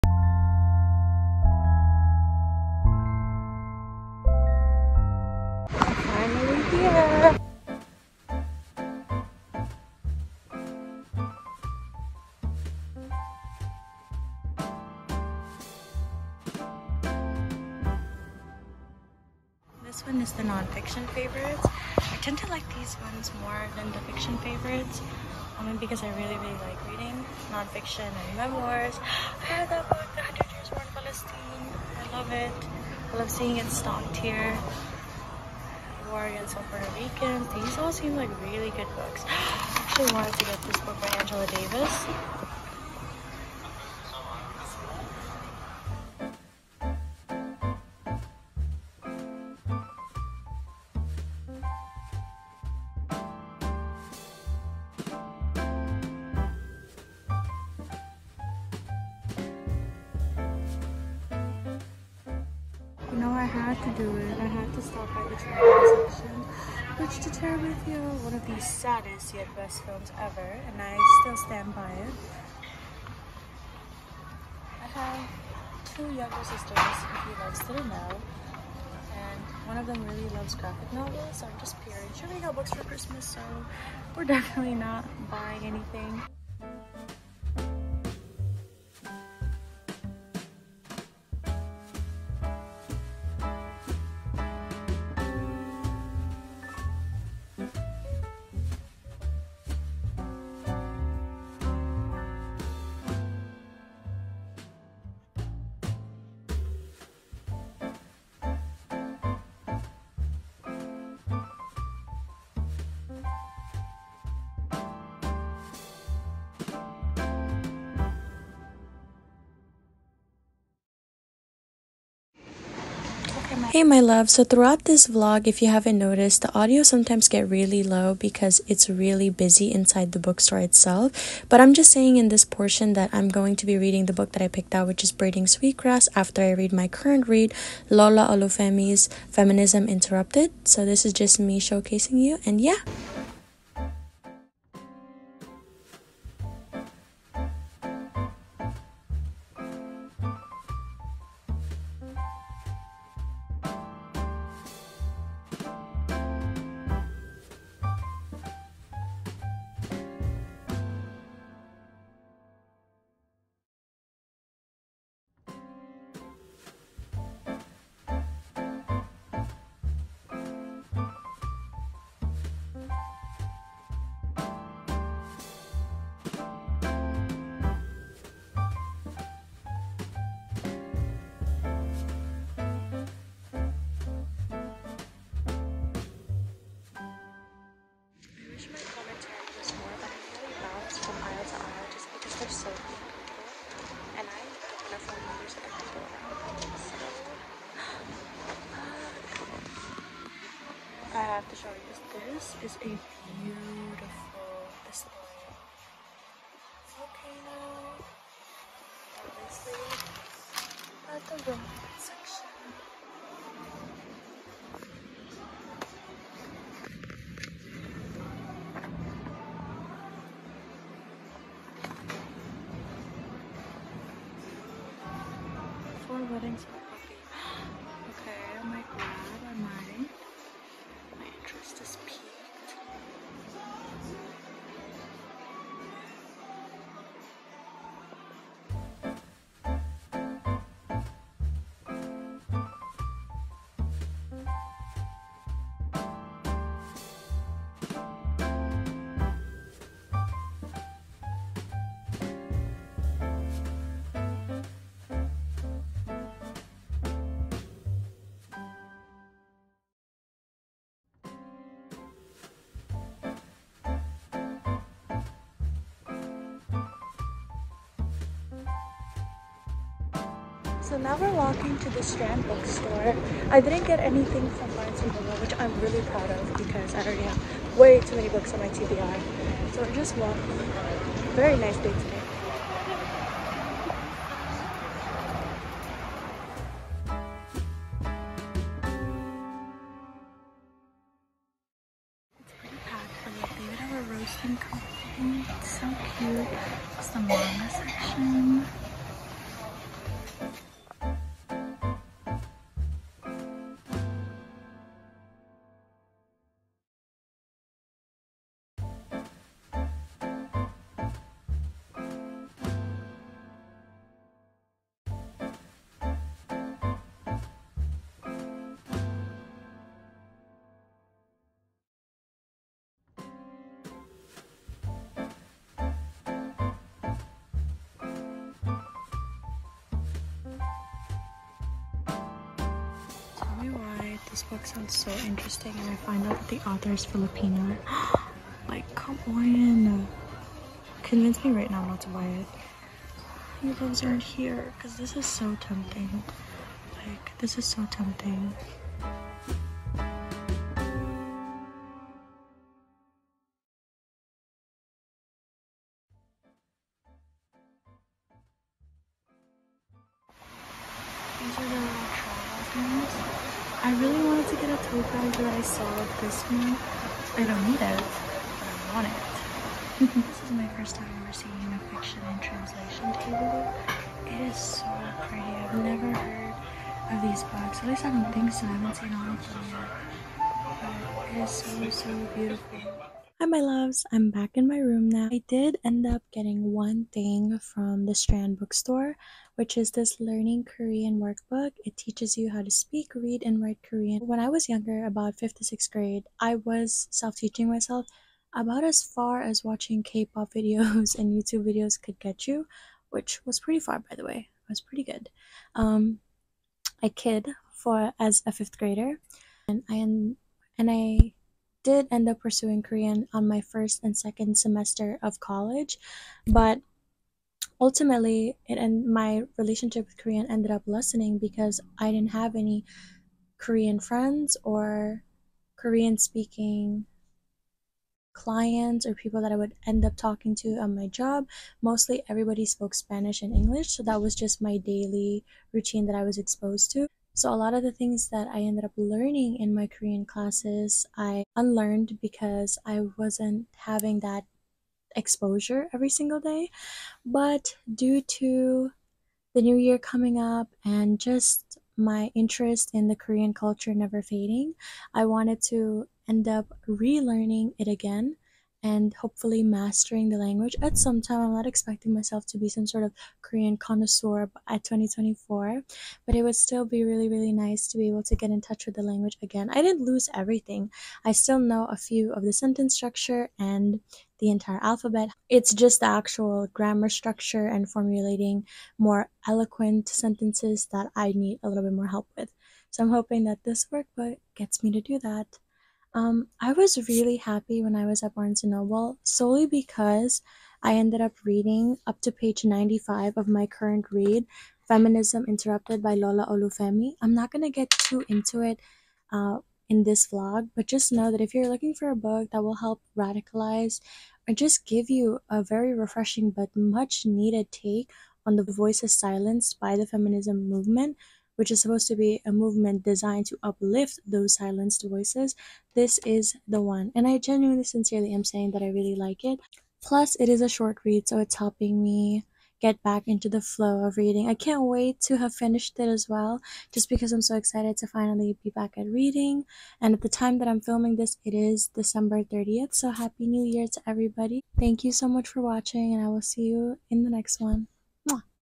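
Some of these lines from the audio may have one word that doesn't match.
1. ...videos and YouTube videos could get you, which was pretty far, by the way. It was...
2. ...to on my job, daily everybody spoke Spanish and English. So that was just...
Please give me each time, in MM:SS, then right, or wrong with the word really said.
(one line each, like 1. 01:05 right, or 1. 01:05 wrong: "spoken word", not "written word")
1. 06:40 right
2. 07:10 wrong: "mostly", not "daily".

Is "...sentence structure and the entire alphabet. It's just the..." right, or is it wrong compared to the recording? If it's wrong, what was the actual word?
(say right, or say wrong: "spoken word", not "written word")
right.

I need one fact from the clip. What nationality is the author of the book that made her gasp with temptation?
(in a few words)
Filipino.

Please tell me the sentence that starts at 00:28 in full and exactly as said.
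I have that book, The Hundred Years War in Palestine.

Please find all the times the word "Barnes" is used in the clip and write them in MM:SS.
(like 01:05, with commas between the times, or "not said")
04:34, 08:08.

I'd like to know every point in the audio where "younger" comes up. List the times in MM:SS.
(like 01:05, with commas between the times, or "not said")
01:16, 06:34.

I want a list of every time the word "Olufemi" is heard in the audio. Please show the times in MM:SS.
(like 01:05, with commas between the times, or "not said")
02:18, 08:16.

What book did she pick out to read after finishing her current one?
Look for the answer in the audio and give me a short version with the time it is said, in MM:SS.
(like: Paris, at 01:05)
Braiding Sweetgrass, at 02:15.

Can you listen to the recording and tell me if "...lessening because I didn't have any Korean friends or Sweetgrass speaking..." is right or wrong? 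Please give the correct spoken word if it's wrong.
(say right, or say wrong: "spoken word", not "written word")
wrong: "Korean", not "Sweetgrass".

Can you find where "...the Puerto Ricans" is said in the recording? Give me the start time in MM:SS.
00:36.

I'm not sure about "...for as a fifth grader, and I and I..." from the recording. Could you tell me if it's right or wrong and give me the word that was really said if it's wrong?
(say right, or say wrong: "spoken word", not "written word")
right.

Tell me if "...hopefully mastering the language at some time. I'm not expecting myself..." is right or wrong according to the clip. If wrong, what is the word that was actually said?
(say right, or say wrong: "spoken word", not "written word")
right.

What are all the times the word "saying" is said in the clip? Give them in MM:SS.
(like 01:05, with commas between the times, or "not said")
02:11, 08:38.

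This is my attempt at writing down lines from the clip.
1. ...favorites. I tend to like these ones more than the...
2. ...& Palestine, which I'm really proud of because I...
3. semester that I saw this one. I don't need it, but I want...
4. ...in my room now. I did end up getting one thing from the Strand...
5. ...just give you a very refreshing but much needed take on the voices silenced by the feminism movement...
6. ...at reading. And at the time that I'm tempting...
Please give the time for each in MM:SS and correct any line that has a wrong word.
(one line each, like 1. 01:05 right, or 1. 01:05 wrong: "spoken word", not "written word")
1. 00:21 right
2. 04:35 wrong: "Noble", not "Palestine"
3. 06:04 wrong: "paper", not "semester"
4. 06:24 right
5. 08:24 right
6. 08:48 wrong: "filming", not "tempting".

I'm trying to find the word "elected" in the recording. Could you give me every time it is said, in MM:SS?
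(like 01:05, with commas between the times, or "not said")
not said.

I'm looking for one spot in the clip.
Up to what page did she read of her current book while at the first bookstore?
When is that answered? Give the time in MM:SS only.
08:12.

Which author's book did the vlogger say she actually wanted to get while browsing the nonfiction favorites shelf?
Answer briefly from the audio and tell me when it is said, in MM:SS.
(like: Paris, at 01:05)
Angela Davis, at 00:41.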